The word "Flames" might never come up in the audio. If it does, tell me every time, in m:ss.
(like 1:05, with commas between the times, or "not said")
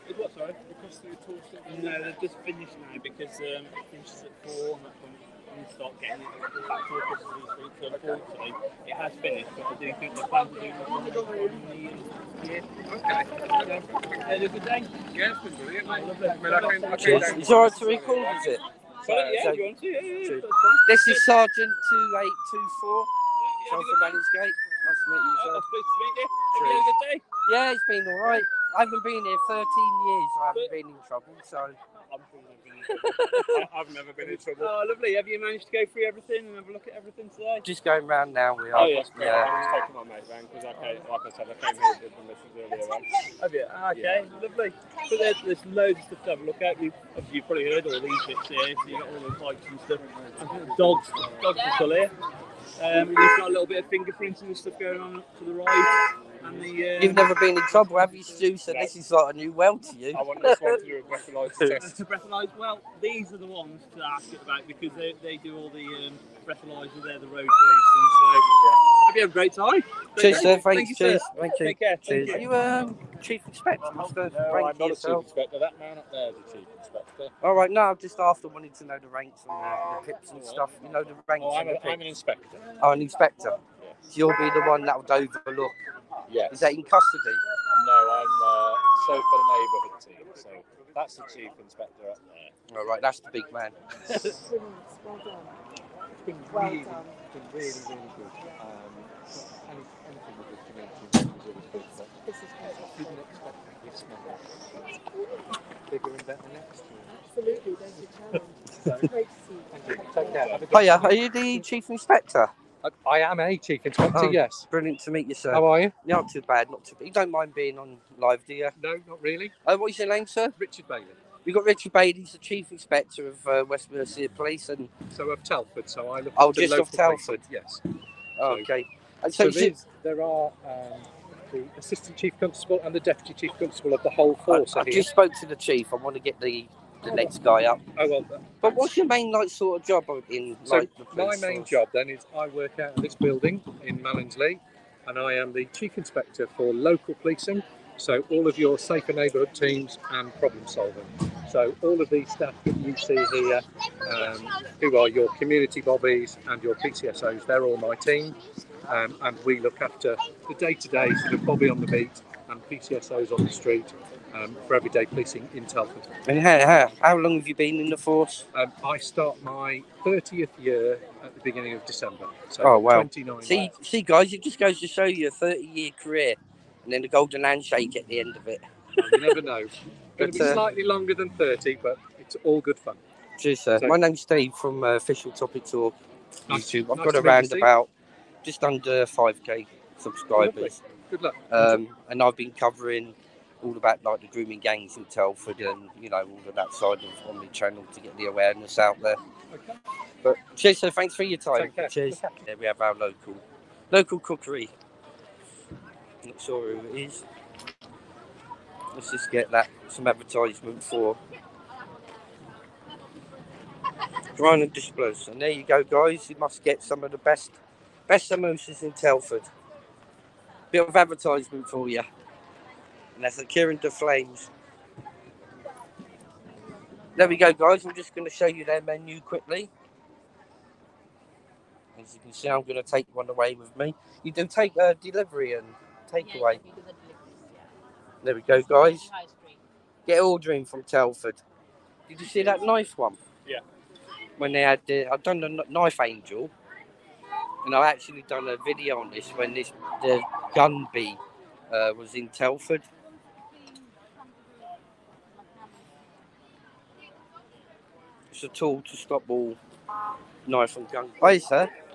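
3:43.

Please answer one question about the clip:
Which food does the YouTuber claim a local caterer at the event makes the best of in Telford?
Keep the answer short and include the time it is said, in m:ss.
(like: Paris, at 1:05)
samosas, at 3:38.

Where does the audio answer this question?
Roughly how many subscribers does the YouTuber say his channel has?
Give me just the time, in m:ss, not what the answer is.
3:08.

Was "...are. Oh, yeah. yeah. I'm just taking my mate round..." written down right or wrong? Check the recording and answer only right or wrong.
right.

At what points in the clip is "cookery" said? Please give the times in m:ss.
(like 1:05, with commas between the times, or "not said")
3:24.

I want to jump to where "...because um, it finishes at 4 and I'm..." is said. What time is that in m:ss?
0:03.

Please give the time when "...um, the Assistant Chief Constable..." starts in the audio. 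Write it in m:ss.
2:10.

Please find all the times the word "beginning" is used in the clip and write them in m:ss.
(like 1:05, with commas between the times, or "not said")
2:51.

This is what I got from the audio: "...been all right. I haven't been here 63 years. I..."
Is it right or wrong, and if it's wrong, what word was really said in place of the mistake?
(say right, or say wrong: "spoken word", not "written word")
wrong: "13", not "63".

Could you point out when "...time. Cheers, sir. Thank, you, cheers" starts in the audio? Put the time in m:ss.
1:09.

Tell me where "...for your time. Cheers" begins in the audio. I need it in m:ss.
3:21.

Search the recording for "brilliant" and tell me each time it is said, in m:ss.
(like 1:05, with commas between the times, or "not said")
0:15, 1:54.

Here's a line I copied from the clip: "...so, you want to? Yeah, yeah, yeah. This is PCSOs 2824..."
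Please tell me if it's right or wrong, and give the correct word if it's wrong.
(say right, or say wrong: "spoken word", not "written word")
wrong: "Sergeant", not "PCSOs".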